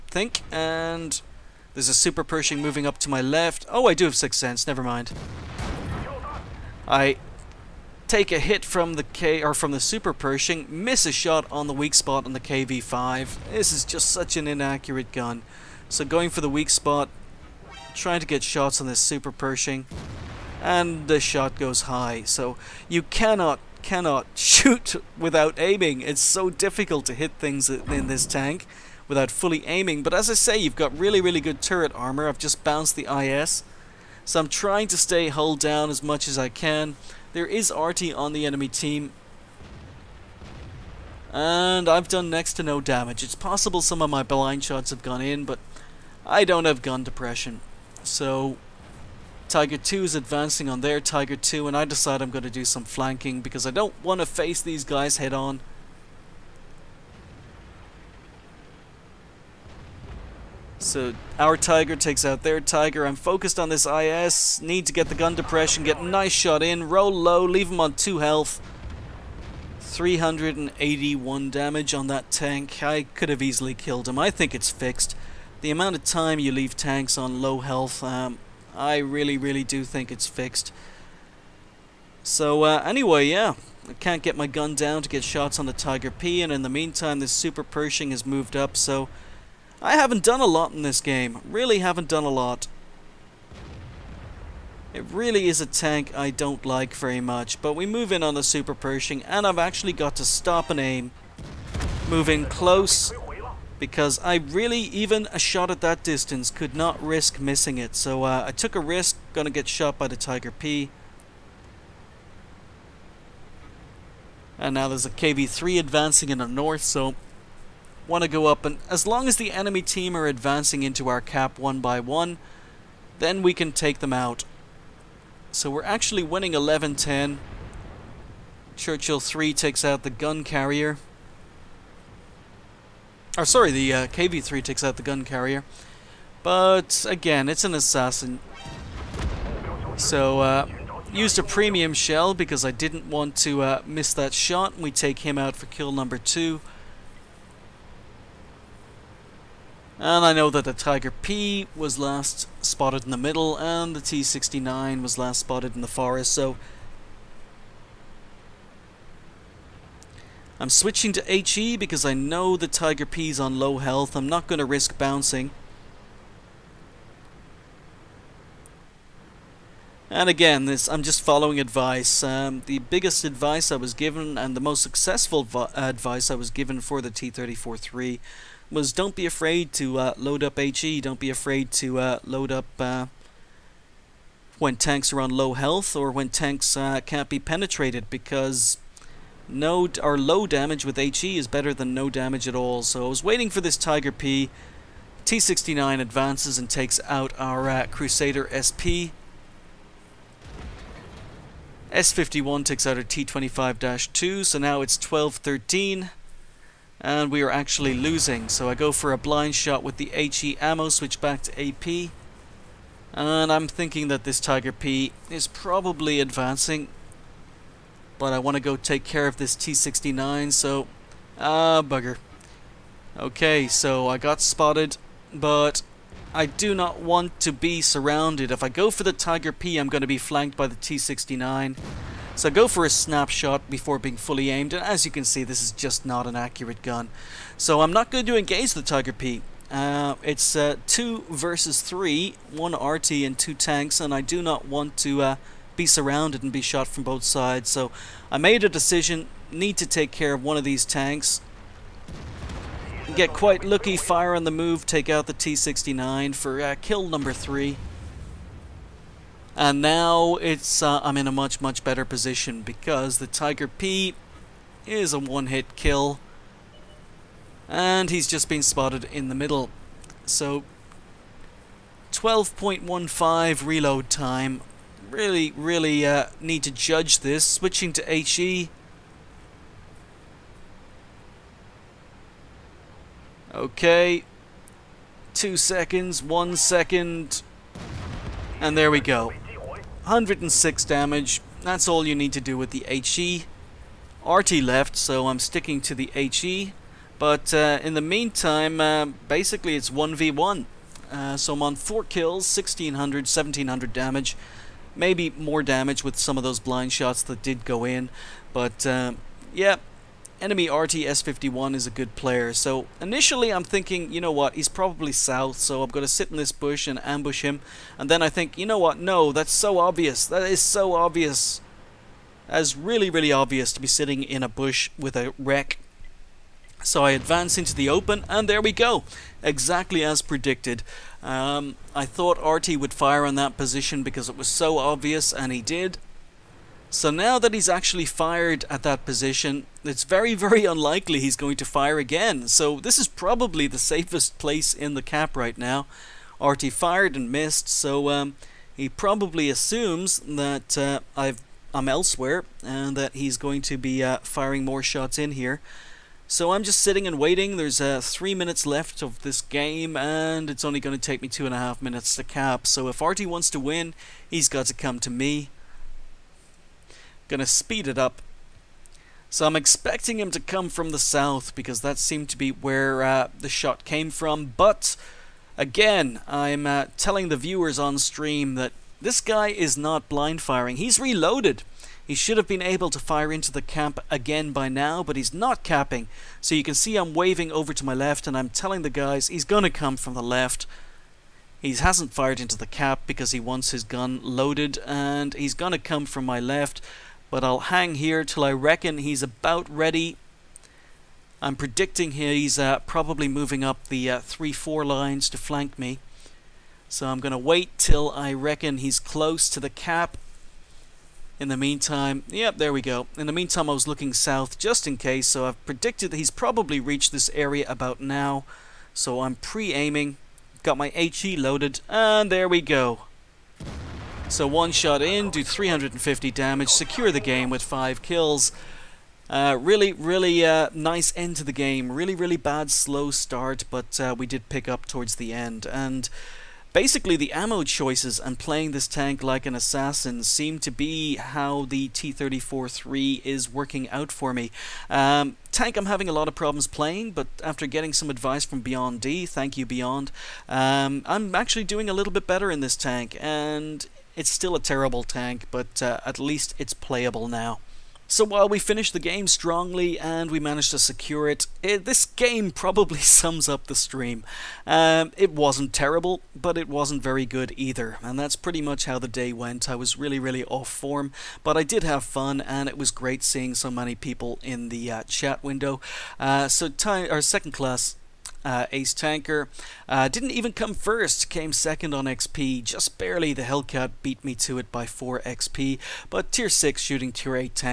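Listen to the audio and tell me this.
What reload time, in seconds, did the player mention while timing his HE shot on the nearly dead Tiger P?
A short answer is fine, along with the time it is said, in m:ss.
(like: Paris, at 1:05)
12.15, at 4:32.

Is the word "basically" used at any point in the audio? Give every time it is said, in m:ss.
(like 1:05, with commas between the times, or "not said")
4:59, 7:16.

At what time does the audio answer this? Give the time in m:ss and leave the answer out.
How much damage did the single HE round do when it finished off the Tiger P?
4:50.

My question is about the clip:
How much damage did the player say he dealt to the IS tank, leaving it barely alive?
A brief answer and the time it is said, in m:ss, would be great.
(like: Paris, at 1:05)
381, at 1:09.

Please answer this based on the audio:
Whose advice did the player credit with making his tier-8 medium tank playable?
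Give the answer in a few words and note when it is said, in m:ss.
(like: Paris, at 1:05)
Beyond D, at 7:28.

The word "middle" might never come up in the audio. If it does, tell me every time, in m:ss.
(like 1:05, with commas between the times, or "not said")
2:33, 4:29.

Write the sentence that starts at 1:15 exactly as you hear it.
The amount of time you leave tanks on low health, um, I really, really do think it's fixed.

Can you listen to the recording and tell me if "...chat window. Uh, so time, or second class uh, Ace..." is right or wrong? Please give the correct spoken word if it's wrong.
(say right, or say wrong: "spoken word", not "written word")
right.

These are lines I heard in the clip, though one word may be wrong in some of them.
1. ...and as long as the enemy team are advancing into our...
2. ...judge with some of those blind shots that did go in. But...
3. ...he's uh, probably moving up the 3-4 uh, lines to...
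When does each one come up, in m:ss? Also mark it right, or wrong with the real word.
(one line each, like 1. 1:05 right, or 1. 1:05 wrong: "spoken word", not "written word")
1. 1:58 right
2. 5:05 wrong: "damage", not "judge"
3. 6:42 right.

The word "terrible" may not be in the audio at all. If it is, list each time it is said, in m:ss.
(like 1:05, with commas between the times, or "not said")
7:34, 7:45.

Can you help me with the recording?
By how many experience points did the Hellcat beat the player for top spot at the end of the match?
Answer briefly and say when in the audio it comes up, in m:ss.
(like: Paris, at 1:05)
4, at 8:04.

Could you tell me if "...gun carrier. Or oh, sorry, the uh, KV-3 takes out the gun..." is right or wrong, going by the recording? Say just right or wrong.
right.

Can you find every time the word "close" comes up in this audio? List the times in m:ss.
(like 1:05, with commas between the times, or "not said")
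1:42, 6:48.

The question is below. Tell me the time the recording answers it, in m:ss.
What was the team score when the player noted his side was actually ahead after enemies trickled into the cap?
2:06.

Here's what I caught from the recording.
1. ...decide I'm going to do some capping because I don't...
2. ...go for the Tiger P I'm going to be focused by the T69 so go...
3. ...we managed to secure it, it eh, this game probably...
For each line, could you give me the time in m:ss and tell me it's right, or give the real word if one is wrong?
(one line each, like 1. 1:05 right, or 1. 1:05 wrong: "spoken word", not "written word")
1. 0:51 wrong: "flanking", not "capping"
2. 3:48 wrong: "flanked", not "focused"
3. 7:40 right.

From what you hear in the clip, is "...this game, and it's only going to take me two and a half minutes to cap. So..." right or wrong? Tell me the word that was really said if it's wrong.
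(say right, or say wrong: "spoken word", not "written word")
right.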